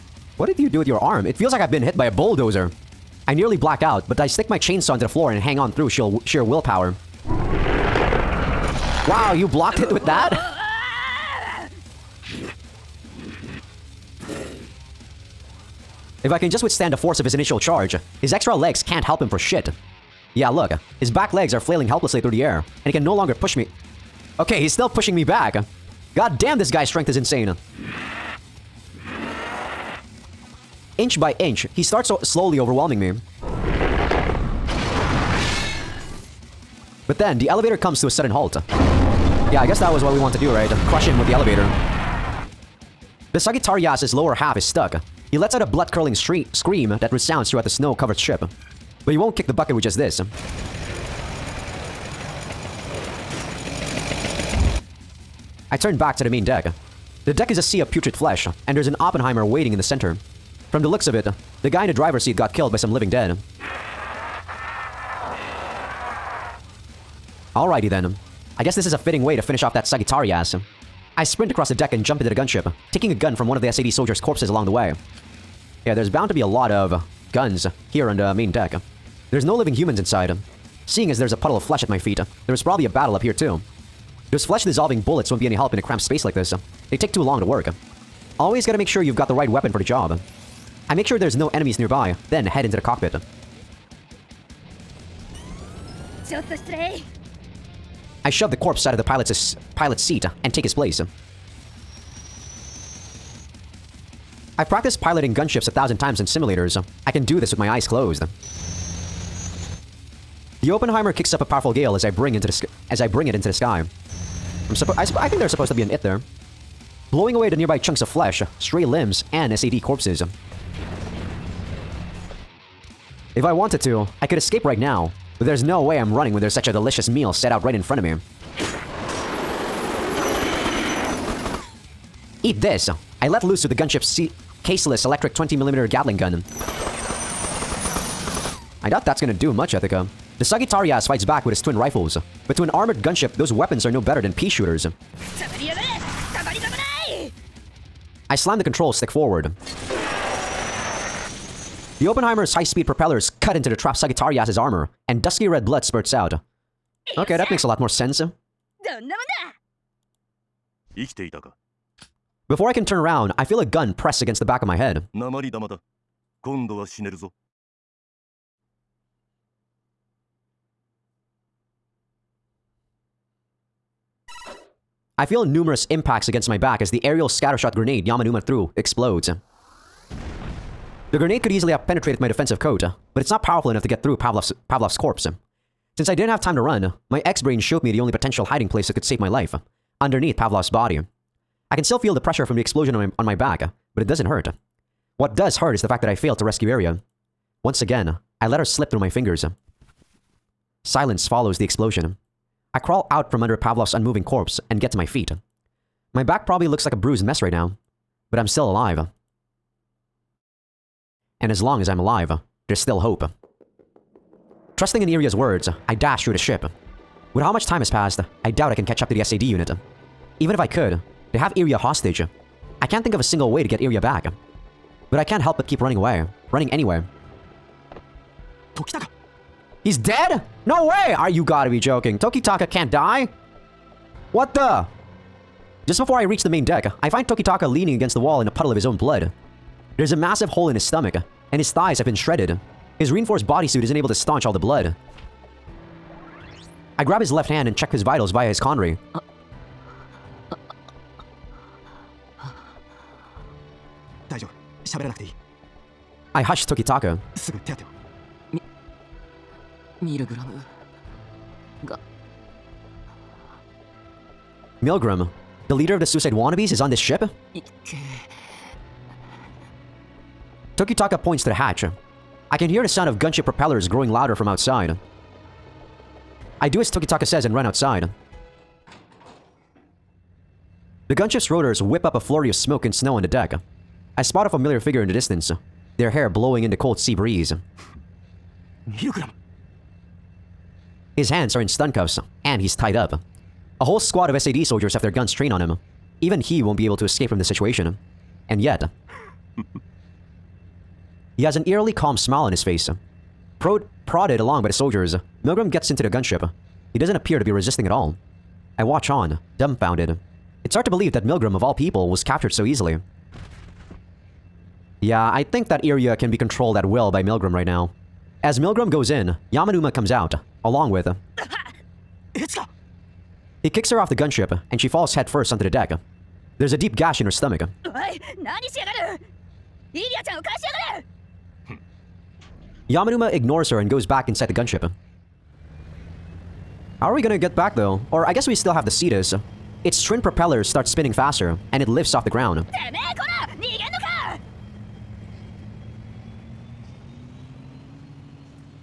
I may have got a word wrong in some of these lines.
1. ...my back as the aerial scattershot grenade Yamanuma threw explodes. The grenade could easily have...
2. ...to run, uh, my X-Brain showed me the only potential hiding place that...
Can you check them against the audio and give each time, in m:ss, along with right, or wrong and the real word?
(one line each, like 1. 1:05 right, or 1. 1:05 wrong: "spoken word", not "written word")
1. 2:56 right
2. 3:06 right.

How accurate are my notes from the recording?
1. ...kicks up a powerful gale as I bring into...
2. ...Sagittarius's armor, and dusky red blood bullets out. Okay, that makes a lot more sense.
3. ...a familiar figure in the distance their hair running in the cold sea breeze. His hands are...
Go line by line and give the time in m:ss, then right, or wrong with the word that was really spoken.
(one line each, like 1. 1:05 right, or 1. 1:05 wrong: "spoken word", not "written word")
1. 1:51 right
2. 2:33 wrong: "spurts", not "bullets"
3. 4:44 wrong: "blowing", not "running".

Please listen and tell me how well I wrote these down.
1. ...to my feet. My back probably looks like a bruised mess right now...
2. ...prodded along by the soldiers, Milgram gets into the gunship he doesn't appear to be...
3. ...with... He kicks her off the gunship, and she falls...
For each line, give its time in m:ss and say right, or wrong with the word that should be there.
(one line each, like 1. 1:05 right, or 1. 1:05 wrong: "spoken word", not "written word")
1. 3:24 right
2. 5:04 right
3. 5:20 right.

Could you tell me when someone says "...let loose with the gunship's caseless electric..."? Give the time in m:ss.
2:13.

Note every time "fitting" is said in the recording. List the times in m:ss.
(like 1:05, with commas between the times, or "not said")
1:08.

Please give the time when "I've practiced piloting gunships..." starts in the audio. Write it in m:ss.
1:44.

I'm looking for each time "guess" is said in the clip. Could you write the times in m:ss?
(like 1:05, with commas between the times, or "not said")
0:39, 1:08, 5:38.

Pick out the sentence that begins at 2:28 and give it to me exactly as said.
I slam the control stick forward.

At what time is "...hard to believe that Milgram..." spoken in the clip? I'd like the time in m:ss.
5:10.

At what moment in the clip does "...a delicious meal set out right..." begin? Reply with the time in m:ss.
2:06.